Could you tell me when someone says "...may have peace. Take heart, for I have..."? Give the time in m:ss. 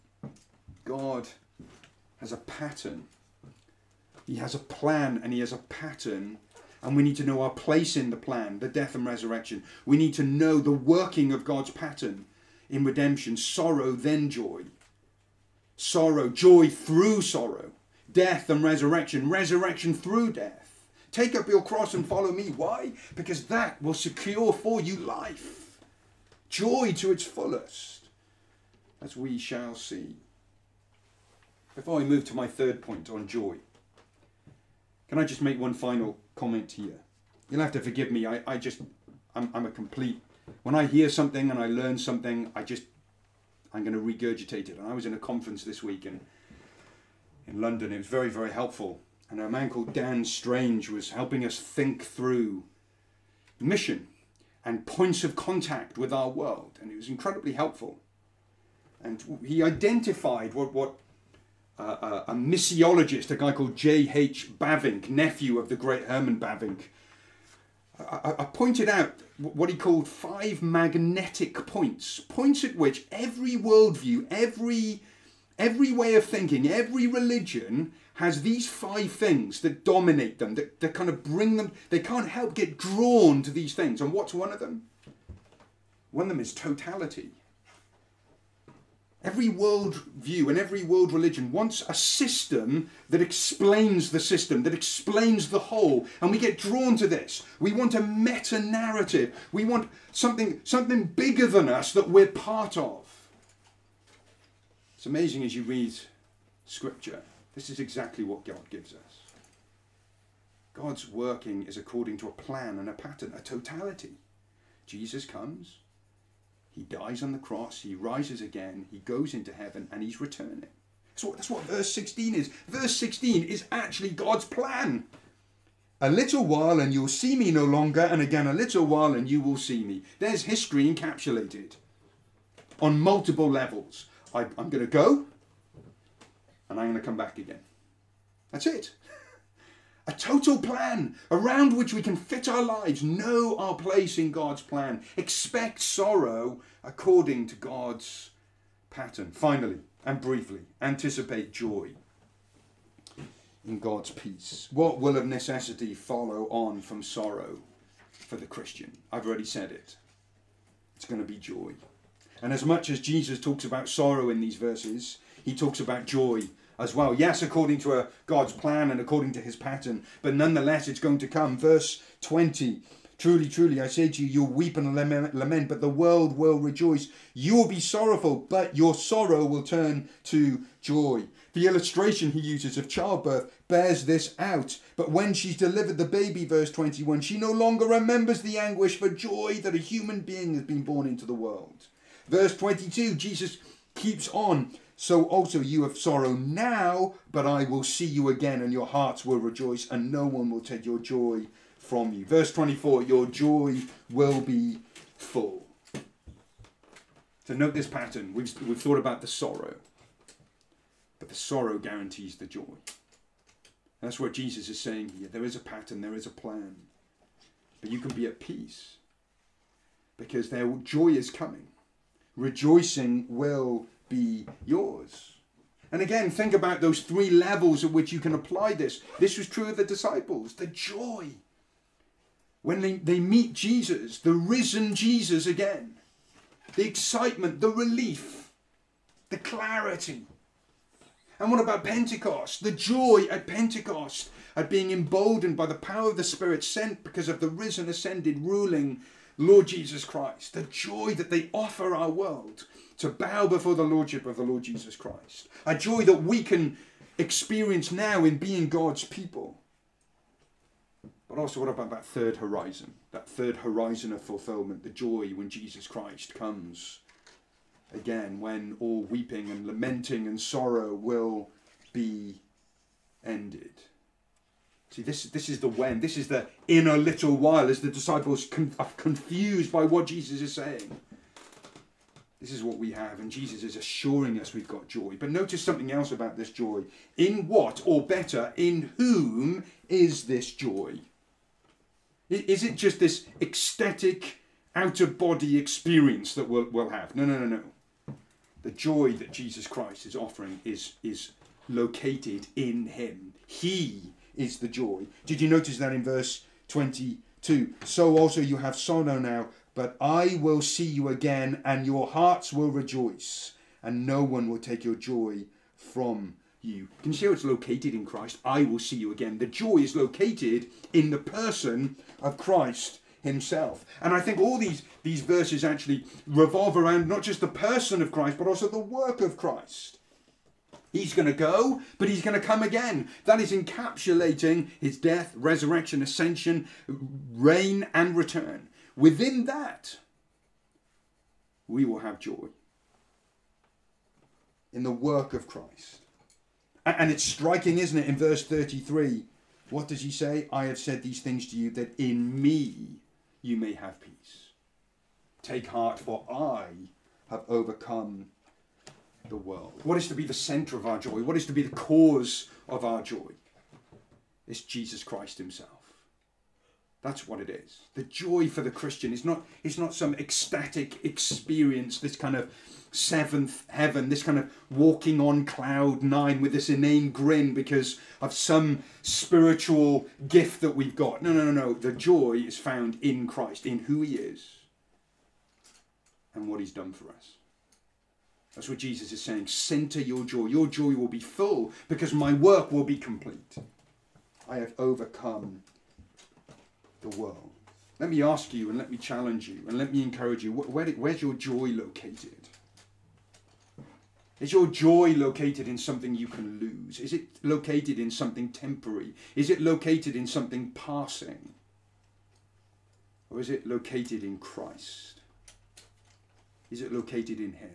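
5:53.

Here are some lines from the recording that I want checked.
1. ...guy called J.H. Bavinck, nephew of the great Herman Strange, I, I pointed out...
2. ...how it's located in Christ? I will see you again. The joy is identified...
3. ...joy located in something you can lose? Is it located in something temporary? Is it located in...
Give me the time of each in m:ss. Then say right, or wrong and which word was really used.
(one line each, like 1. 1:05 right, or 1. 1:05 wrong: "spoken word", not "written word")
1. 1:03 wrong: "Bavinck", not "Strange"
2. 5:17 wrong: "located", not "identified"
3. 6:44 right.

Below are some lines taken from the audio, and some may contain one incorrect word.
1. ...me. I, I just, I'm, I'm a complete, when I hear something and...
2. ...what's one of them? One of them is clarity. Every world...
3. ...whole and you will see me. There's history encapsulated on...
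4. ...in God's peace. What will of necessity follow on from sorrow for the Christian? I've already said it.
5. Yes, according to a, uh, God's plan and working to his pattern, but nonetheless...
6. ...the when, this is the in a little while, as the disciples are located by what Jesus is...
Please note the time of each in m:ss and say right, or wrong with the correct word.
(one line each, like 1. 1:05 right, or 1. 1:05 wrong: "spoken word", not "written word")
1. 0:38 right
2. 1:24 wrong: "totality", not "clarity"
3. 2:08 wrong: "while", not "whole"
4. 2:33 right
5. 2:47 wrong: "according", not "working"
6. 4:35 wrong: "confused", not "located".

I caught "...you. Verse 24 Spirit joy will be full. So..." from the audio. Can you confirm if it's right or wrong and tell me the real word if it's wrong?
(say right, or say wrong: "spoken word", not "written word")
wrong: "Your", not "Spirit".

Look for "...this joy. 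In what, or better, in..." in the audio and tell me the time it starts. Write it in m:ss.
4:46.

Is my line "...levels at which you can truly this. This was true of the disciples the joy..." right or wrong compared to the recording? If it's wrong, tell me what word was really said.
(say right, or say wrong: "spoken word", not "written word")
wrong: "apply", not "truly".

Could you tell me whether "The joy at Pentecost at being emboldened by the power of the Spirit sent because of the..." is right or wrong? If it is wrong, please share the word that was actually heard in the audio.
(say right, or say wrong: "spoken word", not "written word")
right.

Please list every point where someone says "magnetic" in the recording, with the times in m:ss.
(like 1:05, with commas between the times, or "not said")
1:10.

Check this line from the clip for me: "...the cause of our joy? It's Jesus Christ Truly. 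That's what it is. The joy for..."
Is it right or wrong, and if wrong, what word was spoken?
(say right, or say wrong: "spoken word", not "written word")
wrong: "Himself", not "Truly".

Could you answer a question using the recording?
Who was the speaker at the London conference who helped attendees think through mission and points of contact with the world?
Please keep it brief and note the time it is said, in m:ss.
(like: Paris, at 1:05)
Dan Strange, at 0:49.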